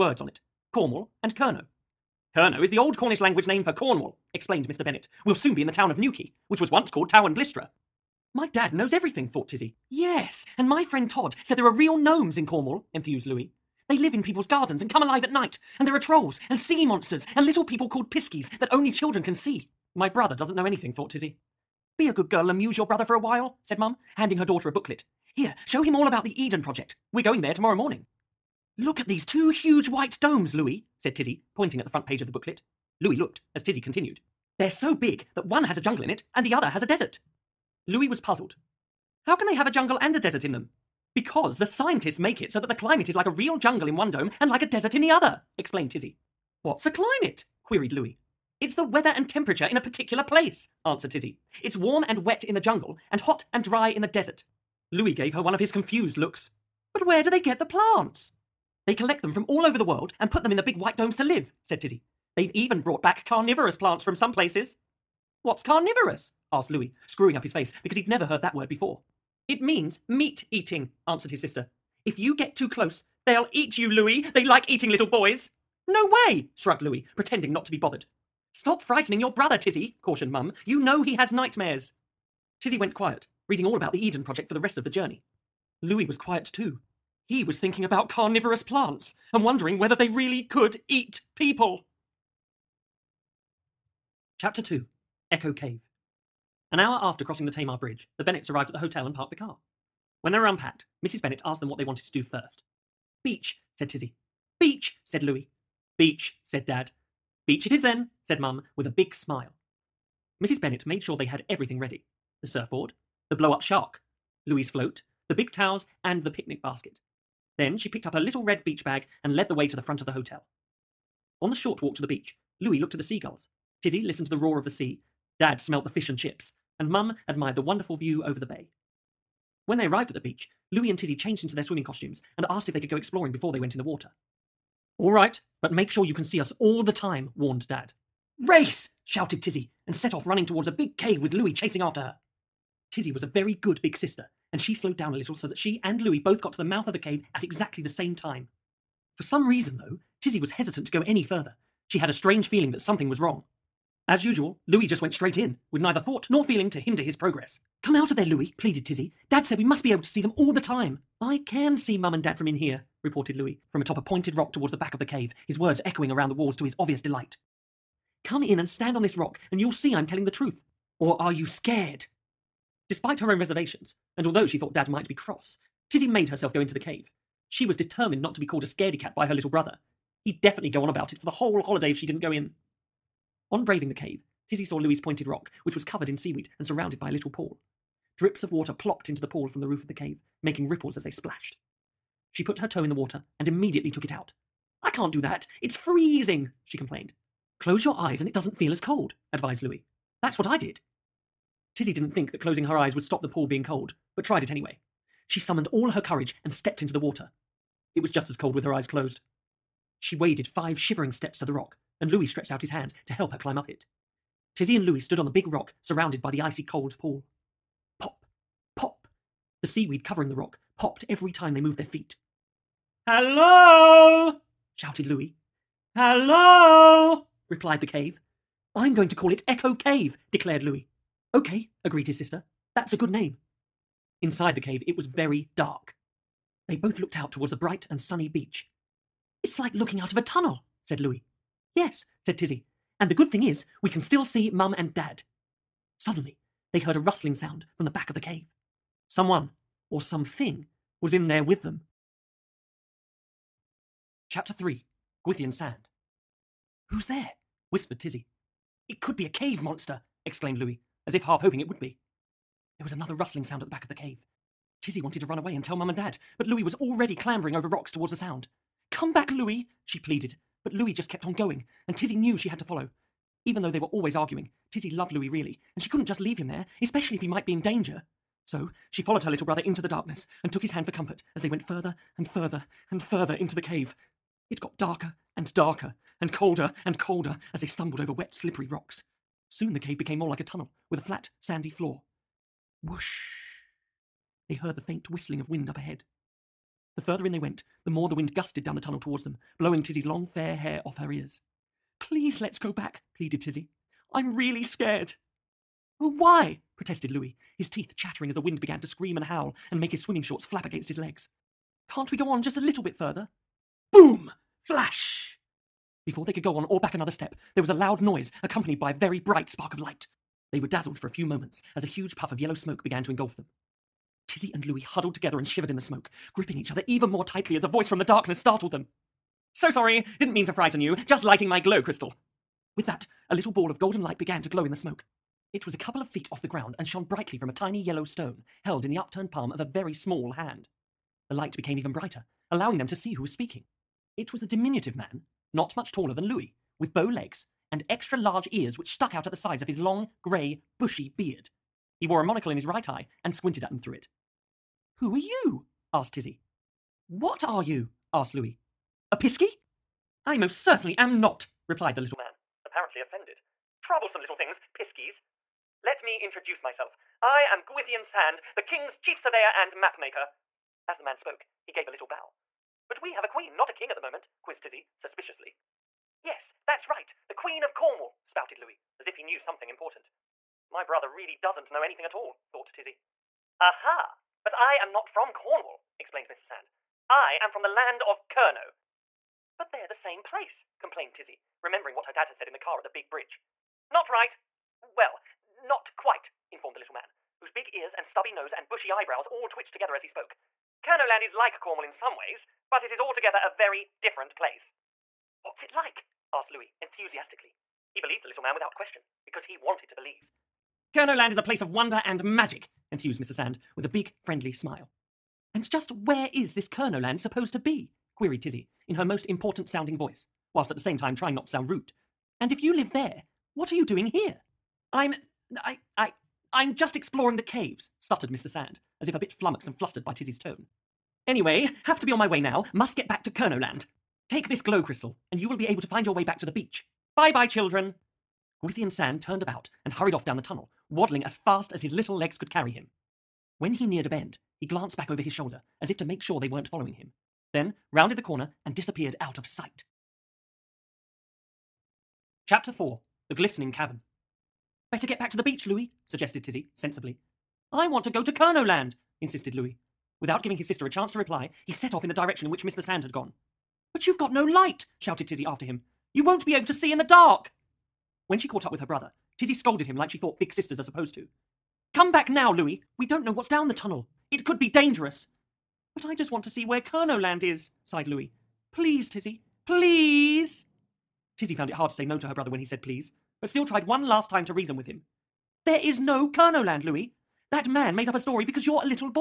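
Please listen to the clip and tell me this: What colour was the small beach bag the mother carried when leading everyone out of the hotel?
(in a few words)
Red.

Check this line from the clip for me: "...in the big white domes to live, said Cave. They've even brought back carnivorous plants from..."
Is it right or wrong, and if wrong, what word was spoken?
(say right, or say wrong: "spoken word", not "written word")
wrong: "Tizzy", not "Cave".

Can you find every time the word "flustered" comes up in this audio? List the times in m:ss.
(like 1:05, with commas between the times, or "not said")
7:09.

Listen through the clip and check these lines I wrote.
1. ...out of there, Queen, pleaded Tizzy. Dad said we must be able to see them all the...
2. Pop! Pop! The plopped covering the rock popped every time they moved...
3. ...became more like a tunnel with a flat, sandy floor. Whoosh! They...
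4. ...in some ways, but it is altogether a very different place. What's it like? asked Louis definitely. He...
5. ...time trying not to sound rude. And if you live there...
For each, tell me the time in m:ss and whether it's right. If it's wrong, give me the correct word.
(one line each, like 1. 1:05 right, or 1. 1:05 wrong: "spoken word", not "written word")
1. 2:37 wrong: "Louis", not "Queen"
2. 3:37 wrong: "seaweed", not "plopped"
3. 4:49 right
4. 6:41 wrong: "enthusiastically", not "definitely"
5. 7:00 right.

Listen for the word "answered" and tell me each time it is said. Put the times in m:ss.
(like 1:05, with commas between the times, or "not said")
0:50, 1:11.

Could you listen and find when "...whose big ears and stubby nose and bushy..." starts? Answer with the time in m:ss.
6:37.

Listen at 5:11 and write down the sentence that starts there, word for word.
Can't we go on just a little bit further?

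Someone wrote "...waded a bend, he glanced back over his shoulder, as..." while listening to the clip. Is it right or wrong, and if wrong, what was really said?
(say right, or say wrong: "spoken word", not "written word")
wrong: "neared", not "waded".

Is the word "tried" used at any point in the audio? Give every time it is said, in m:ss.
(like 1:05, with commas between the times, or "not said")
3:24, 8:03.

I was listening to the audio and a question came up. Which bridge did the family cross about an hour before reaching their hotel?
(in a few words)
Tamar Bridge.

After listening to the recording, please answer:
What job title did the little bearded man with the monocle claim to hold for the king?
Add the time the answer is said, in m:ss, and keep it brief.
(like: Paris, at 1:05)
Chief surveyor and mapmaker, at 6:08.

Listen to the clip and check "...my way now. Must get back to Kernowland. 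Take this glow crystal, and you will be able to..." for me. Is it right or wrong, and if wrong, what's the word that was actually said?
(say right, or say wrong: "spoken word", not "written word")
right.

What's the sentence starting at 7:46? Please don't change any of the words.
You won't be able to see in the dark.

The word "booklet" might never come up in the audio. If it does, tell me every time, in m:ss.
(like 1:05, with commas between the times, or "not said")
0:24, 0:32.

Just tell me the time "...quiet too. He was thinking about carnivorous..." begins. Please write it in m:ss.
1:26.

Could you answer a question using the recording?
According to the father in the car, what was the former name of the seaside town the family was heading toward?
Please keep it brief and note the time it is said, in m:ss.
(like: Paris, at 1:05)
Towan Blystra, at 0:07.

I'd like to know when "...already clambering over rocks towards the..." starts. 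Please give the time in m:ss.
4:26.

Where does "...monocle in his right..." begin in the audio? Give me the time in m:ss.
5:52.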